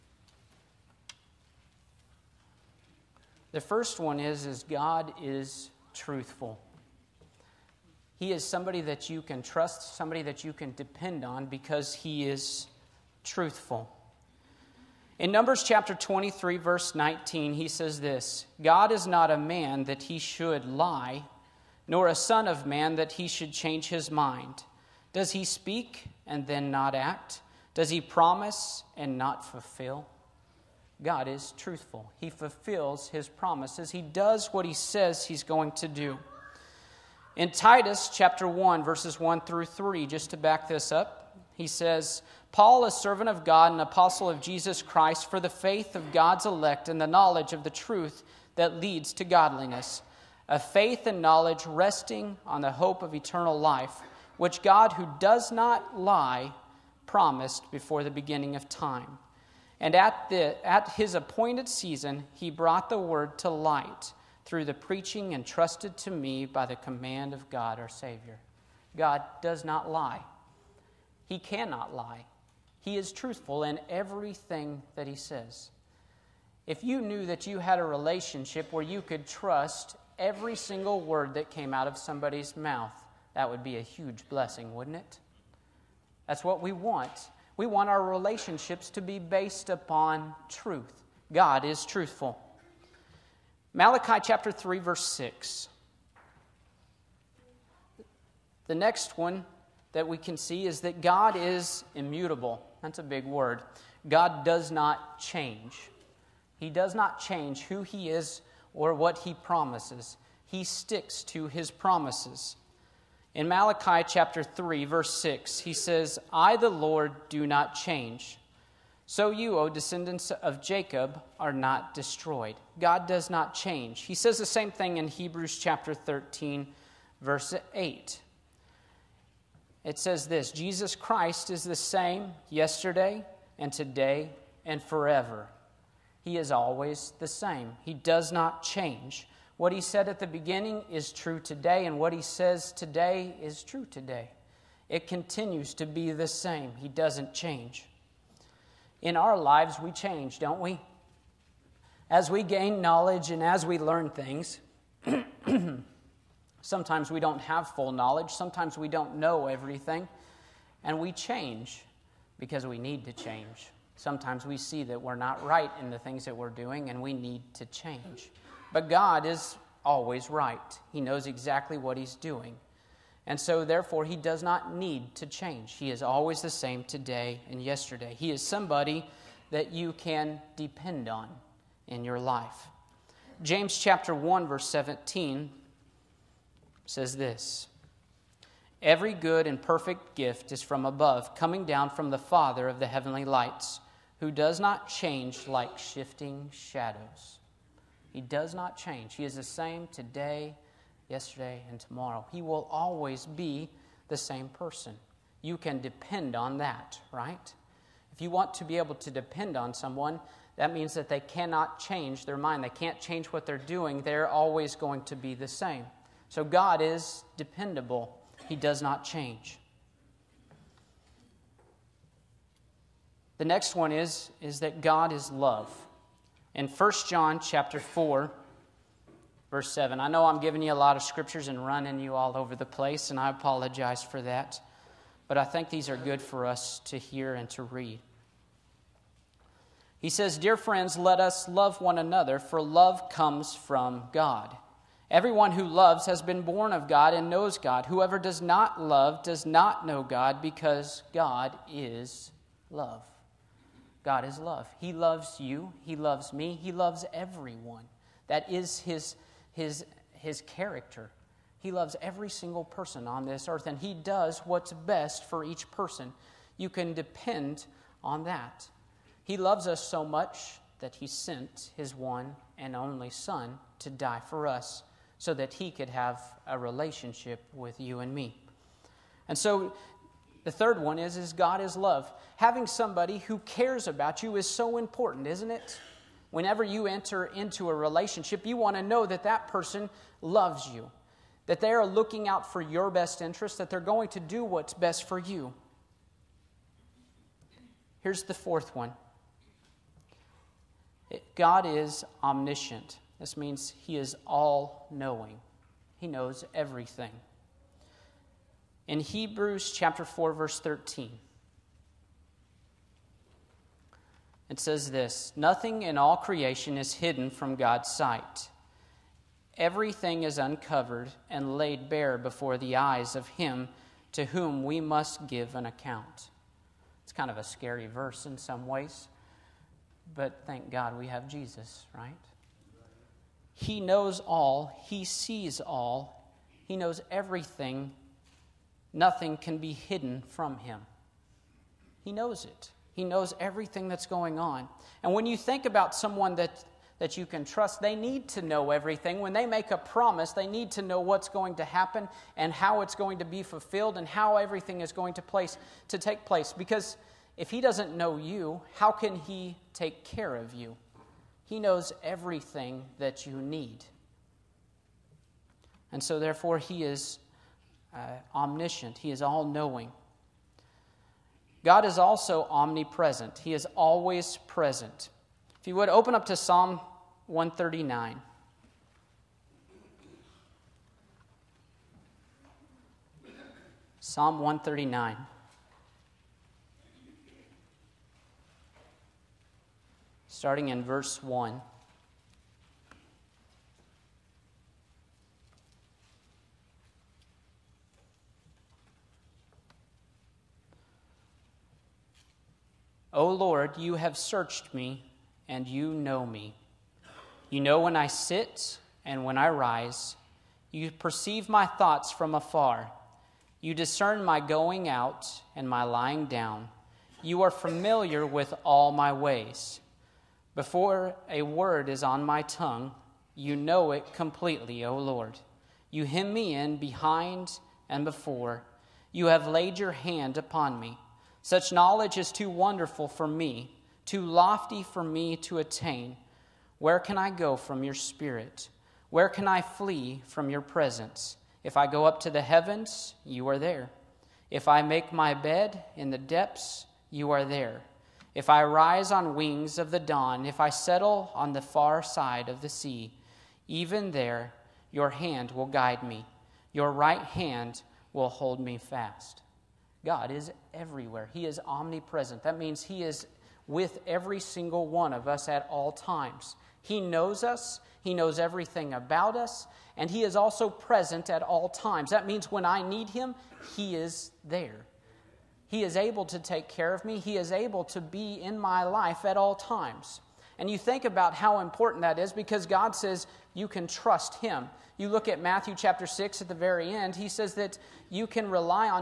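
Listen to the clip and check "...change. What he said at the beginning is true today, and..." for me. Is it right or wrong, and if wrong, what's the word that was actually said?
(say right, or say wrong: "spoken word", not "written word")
right.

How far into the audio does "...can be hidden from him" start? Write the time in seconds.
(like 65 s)
339 s.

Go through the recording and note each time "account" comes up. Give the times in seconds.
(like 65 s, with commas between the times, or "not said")
325 s.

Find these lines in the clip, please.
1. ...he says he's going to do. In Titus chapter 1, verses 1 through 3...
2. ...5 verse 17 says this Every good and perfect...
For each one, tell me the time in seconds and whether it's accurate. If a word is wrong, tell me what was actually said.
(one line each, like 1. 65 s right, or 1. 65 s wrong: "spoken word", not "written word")
1. 34 s right
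2. 184 s wrong: "1", not "5".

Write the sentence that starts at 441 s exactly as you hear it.
If I go up to the heavens, you are there.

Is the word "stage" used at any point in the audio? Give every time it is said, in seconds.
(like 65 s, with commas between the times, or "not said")
not said.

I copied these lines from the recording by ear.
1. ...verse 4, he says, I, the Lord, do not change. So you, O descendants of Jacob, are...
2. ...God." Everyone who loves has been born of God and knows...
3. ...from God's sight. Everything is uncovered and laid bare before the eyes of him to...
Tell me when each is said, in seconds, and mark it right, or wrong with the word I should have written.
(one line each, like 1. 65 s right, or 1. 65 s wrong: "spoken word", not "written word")
1. 114 s wrong: "6", not "4"
2. 244 s right
3. 317 s right.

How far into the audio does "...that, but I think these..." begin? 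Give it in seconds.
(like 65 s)
234 s.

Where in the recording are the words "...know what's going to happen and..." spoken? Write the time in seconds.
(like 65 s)
350 s.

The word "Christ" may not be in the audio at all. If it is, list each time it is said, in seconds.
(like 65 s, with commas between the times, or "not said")
44 s, 130 s.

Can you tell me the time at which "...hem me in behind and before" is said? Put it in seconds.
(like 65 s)
426 s.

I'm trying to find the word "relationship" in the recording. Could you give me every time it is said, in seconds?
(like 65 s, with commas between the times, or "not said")
77 s, 88 s, 276 s, 287 s.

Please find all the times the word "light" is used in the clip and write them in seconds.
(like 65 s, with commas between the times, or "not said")
63 s, 193 s.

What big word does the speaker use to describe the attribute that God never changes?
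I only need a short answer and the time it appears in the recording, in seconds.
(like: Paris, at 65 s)
immutable, at 101 s.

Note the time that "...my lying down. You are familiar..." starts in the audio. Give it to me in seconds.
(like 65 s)
415 s.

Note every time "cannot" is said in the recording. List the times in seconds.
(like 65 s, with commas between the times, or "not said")
71 s, 211 s.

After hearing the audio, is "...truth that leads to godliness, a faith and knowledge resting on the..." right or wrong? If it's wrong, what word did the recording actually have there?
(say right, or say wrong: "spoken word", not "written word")
right.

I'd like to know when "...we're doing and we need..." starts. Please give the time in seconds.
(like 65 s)
166 s.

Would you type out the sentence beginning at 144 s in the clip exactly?
It continues to be the same.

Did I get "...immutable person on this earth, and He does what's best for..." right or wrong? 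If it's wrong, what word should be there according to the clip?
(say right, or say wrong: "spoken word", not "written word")
wrong: "single", not "immutable".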